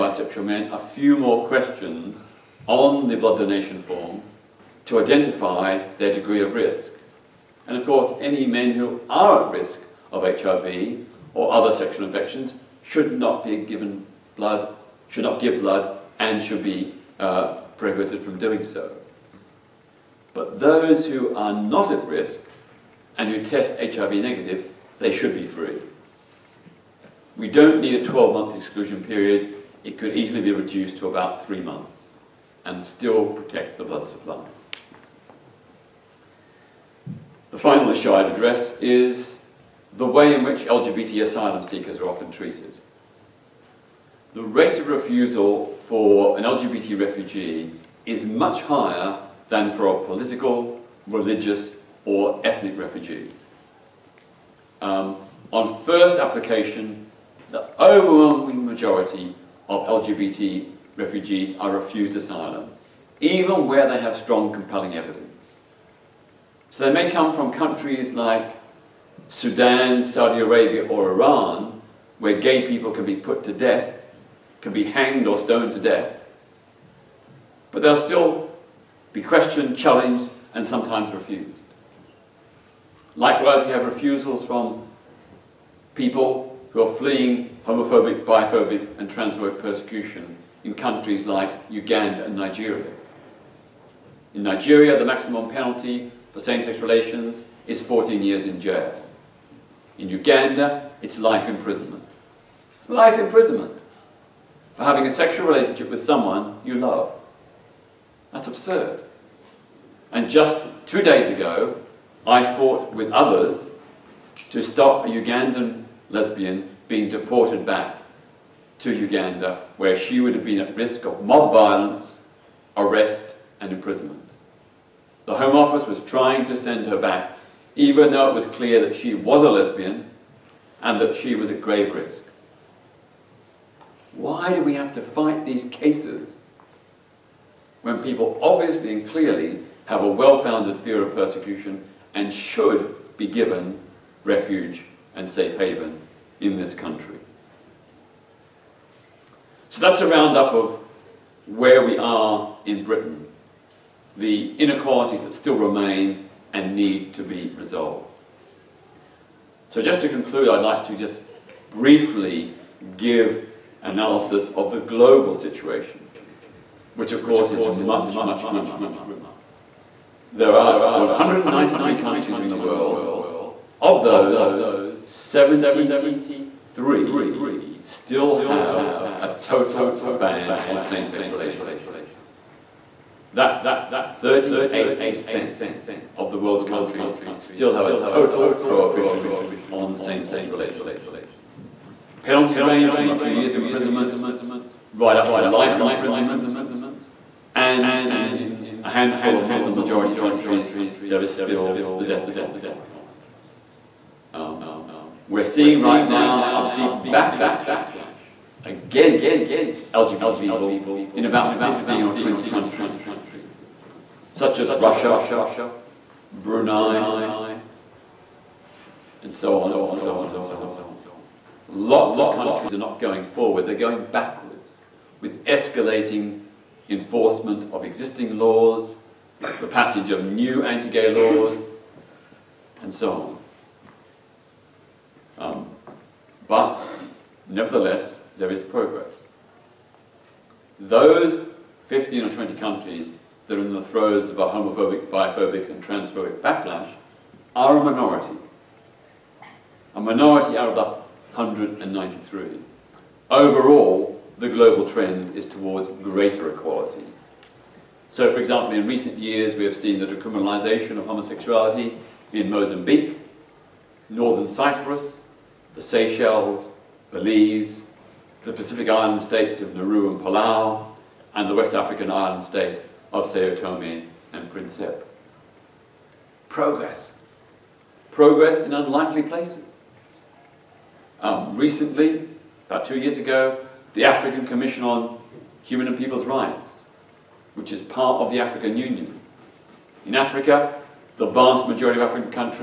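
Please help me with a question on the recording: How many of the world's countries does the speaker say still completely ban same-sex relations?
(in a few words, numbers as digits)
73.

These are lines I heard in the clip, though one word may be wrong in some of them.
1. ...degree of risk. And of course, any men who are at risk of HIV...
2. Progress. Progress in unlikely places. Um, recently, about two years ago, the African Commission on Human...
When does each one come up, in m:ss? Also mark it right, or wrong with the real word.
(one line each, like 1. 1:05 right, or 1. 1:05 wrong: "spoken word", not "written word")
1. 0:06 right
2. 4:36 right.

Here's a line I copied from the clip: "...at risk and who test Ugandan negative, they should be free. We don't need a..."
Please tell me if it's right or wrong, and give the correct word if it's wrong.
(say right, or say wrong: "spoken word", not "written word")
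wrong: "HIV", not "Ugandan".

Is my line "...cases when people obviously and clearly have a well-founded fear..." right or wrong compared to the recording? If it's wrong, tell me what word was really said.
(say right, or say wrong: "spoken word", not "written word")
right.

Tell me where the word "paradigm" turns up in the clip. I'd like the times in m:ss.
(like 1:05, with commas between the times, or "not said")
not said.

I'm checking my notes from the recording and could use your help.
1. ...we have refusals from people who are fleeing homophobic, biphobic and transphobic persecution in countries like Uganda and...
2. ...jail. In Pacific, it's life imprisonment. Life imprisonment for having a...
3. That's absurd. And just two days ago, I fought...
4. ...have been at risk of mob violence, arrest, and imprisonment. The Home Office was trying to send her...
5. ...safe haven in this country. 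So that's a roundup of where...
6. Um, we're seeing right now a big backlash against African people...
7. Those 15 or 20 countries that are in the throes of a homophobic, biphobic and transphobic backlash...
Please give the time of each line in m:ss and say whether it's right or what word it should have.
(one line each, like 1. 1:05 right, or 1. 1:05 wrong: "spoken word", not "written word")
1. 1:23 right
2. 1:38 wrong: "Uganda", not "Pacific"
3. 1:48 right
4. 2:00 right
5. 2:25 right
6. 3:24 wrong: "LGBT", not "African"
7. 4:00 right.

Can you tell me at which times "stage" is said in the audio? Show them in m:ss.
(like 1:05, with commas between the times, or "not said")
not said.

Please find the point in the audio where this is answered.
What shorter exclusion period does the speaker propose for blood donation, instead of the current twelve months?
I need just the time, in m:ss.
0:31.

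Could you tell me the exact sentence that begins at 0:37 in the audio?
The final issue I'd address is the way in which LGBT asylum seekers are often treated.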